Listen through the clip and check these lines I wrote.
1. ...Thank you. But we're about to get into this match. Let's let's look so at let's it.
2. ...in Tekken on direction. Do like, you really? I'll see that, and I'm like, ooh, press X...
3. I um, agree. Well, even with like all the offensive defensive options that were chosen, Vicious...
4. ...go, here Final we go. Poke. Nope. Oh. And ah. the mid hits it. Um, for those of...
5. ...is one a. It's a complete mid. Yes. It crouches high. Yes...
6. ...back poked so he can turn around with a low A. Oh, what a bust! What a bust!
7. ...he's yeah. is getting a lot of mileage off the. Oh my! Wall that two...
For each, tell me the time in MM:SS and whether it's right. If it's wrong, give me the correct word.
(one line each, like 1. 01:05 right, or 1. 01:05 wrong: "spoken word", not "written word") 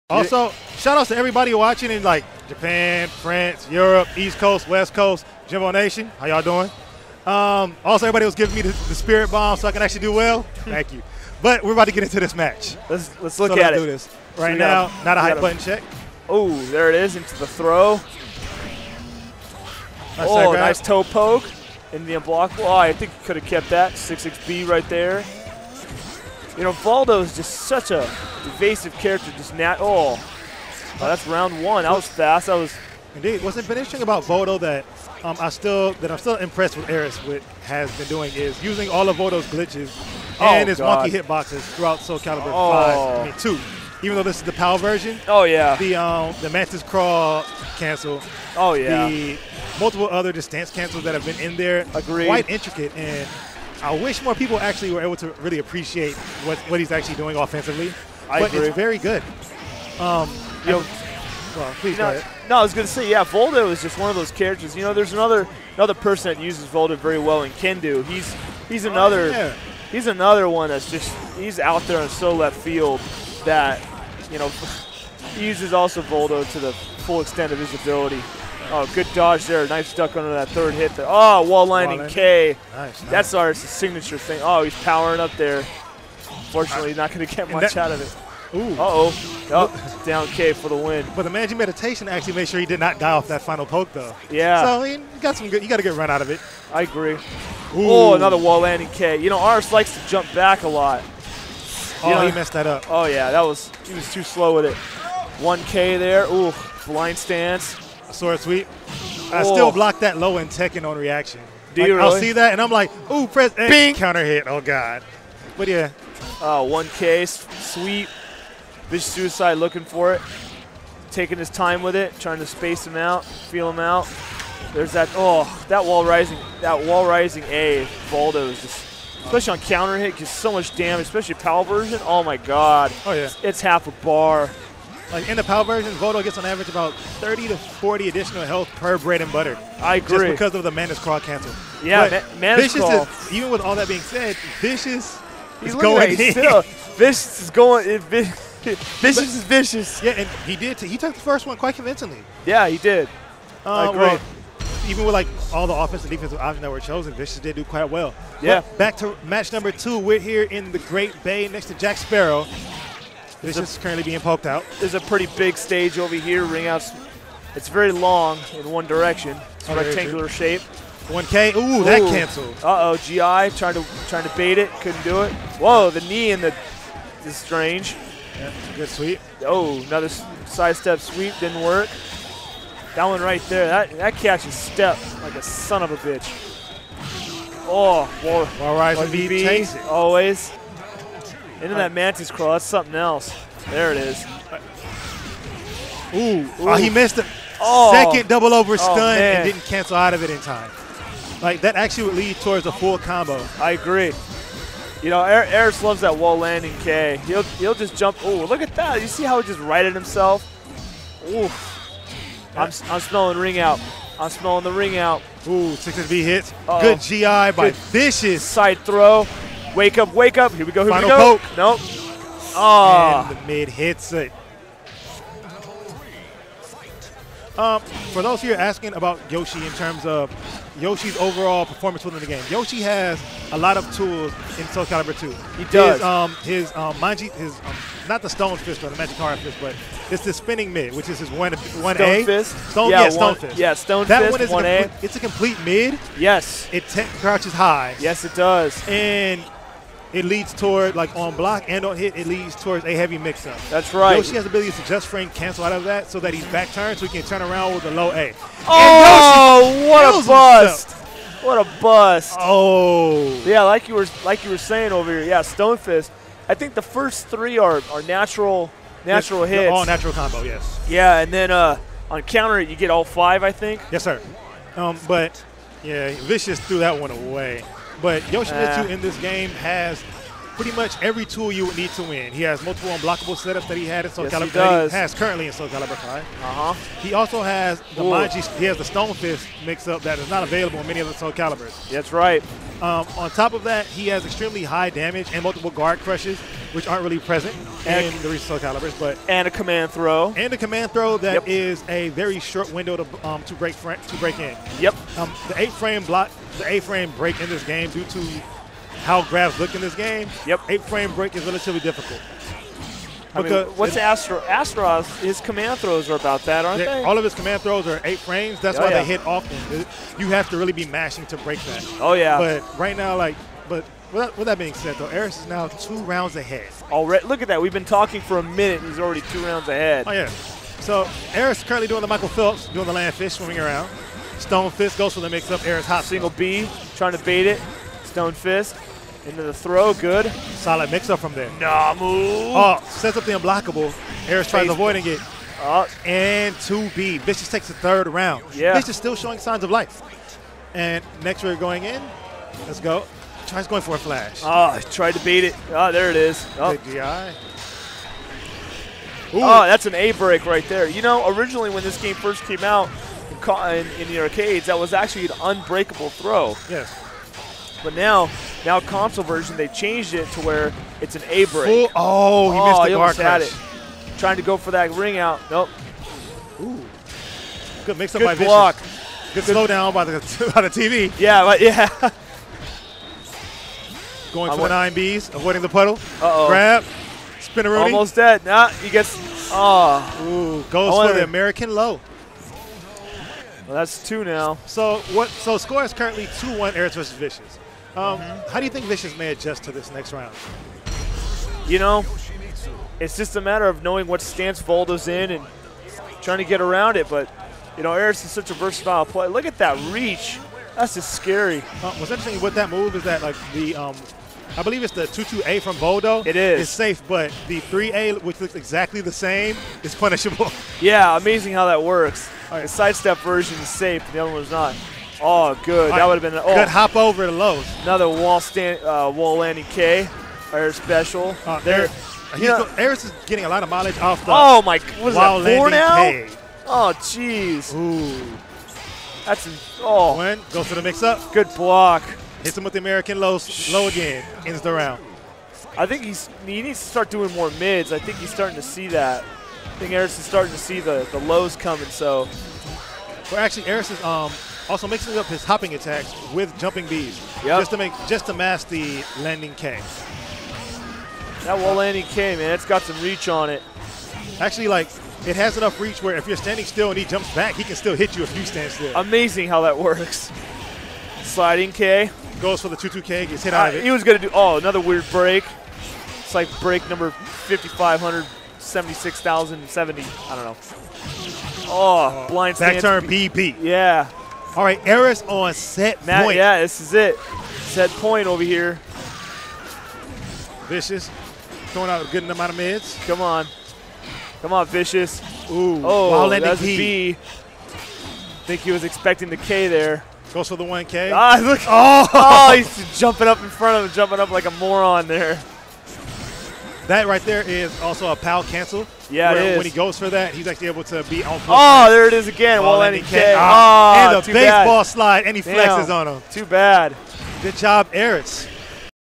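1. 00:10 right
2. 01:50 wrong: "reaction", not "direction"
3. 02:33 right
4. 03:40 right
5. 04:04 right
6. 04:16 wrong: "turned", not "poked"
7. 07:12 wrong: "four", not "two".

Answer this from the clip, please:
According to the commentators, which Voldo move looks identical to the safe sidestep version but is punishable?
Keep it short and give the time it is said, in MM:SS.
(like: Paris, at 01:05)
3A, at 06:57.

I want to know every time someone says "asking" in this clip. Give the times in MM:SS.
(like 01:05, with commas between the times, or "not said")
03:48.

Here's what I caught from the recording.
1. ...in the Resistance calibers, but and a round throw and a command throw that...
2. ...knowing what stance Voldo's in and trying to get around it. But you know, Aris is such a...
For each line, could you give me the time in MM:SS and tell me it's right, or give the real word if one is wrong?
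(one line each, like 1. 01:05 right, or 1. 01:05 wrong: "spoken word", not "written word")
1. 04:58 wrong: "command", not "round"
2. 06:43 right.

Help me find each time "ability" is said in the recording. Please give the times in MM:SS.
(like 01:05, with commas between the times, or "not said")
01:17, 04:14.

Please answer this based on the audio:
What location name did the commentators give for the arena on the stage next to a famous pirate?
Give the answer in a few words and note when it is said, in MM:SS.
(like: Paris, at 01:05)
Great Bay, at 02:40.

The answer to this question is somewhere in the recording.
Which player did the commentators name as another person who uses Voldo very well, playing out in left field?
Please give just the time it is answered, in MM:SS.
01:07.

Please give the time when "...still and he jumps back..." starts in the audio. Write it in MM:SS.
07:46.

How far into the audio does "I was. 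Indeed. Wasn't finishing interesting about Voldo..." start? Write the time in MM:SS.
00:32.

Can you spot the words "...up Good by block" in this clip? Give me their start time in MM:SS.
06:18.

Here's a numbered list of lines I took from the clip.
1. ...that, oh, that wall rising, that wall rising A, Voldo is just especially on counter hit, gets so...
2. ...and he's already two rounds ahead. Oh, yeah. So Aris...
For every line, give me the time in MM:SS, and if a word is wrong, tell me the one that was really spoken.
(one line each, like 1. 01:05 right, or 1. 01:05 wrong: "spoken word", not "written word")
1. 02:04 right
2. 05:28 right.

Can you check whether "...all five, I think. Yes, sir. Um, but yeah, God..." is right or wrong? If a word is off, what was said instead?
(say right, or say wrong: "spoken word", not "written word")
wrong: "Vicious", not "God".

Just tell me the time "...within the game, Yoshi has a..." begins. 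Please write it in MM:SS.
03:52.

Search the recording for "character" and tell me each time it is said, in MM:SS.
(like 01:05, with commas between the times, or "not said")
00:28, 01:04.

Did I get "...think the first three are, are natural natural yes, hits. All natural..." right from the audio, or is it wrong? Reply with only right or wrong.
right.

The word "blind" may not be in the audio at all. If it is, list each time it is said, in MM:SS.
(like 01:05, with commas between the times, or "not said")
01:46, 08:02.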